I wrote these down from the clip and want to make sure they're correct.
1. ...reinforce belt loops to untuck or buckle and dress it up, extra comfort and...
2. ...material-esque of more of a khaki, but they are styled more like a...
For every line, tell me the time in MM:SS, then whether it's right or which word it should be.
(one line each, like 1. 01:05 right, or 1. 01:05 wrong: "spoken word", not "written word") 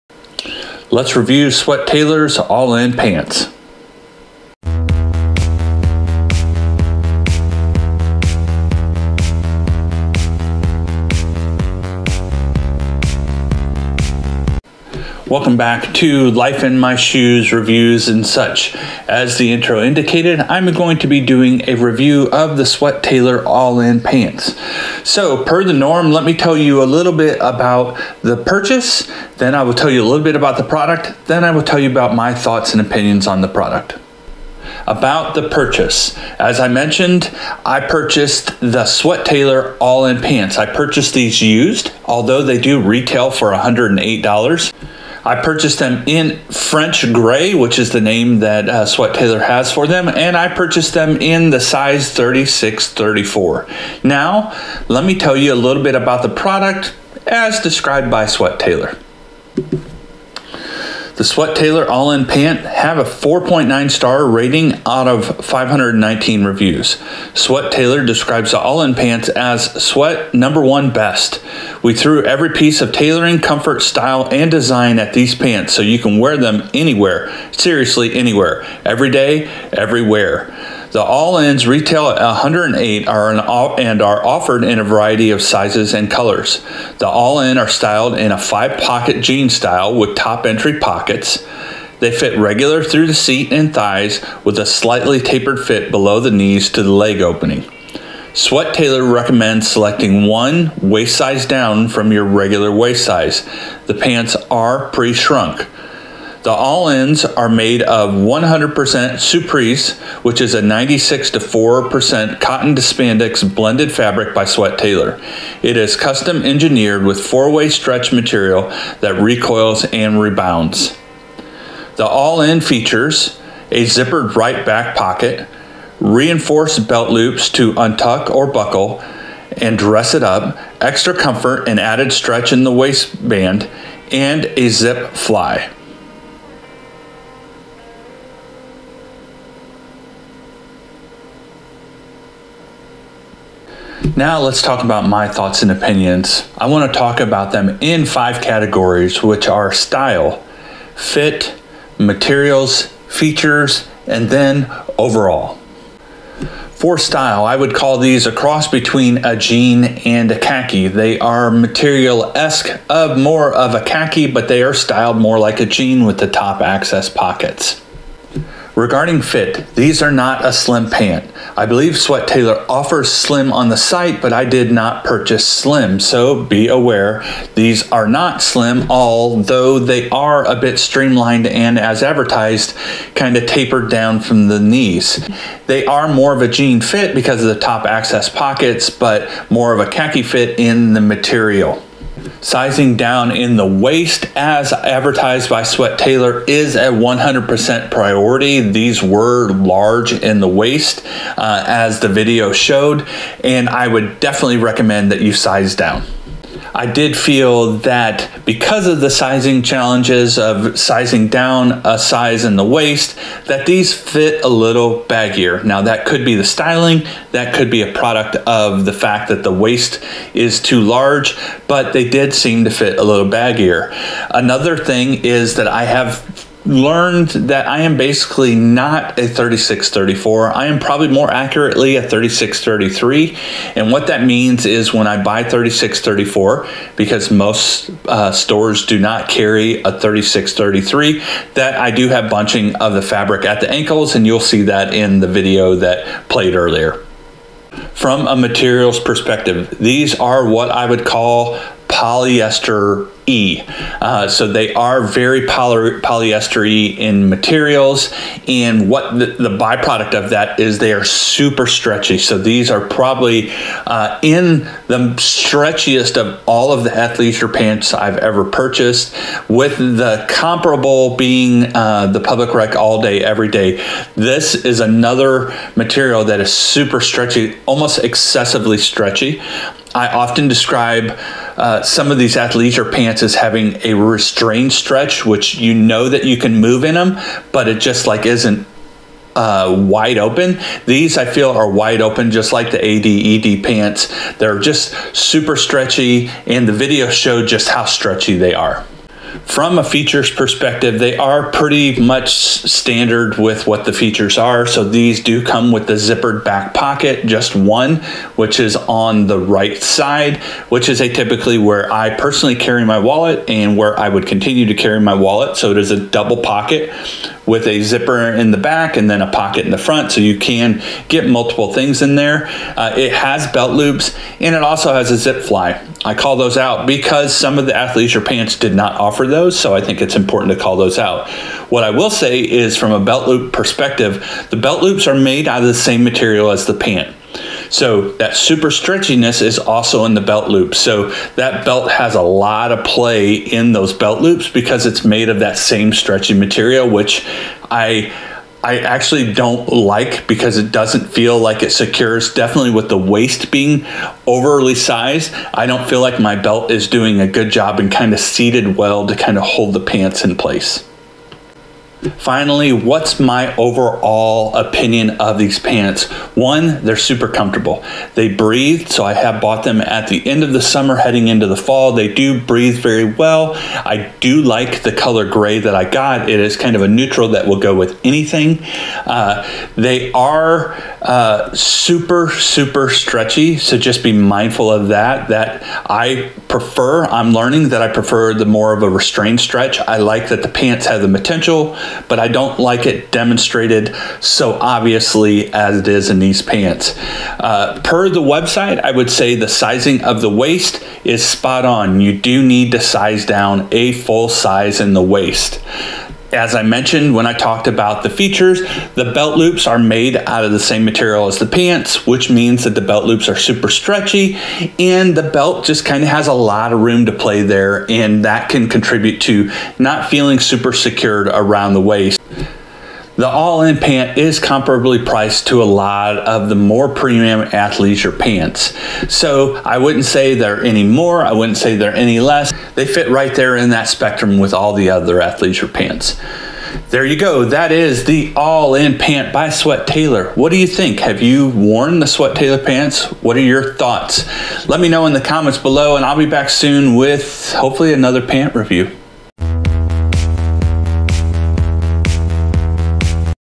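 1. 02:06 right
2. 02:41 right.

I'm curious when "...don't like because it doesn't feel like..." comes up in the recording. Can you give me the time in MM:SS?
05:49.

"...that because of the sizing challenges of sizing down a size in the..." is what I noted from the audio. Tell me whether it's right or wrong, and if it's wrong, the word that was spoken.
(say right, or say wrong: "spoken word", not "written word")
right.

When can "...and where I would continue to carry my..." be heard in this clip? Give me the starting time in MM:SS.
05:13.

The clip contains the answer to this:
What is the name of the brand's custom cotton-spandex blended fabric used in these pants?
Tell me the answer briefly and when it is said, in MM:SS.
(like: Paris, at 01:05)
Suprese, at 01:49.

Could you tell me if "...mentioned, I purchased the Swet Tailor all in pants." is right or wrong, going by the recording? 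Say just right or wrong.
right.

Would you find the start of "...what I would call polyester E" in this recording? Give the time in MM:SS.
04:10.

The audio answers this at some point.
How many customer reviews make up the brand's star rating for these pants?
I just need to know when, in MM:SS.
01:05.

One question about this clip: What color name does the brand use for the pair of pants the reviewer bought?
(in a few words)
French gray.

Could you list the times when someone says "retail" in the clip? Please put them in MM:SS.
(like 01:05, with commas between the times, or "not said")
00:42, 01:21.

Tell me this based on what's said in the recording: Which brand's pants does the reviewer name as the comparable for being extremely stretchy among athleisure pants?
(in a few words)
Public Rec.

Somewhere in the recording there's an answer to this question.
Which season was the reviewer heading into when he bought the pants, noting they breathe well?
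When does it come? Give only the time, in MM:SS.
06:11.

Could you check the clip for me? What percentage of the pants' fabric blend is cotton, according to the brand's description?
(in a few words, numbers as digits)
96%.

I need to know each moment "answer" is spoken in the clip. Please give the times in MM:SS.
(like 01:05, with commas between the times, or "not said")
not said.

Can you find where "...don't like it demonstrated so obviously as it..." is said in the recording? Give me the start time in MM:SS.
06:32.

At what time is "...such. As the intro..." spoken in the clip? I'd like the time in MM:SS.
00:18.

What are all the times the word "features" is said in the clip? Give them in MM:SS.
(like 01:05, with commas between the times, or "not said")
02:02, 02:33, 04:59, 05:03, 06:48.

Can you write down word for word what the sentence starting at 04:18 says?
And what the, the, byproduct of that is they are super stretchy.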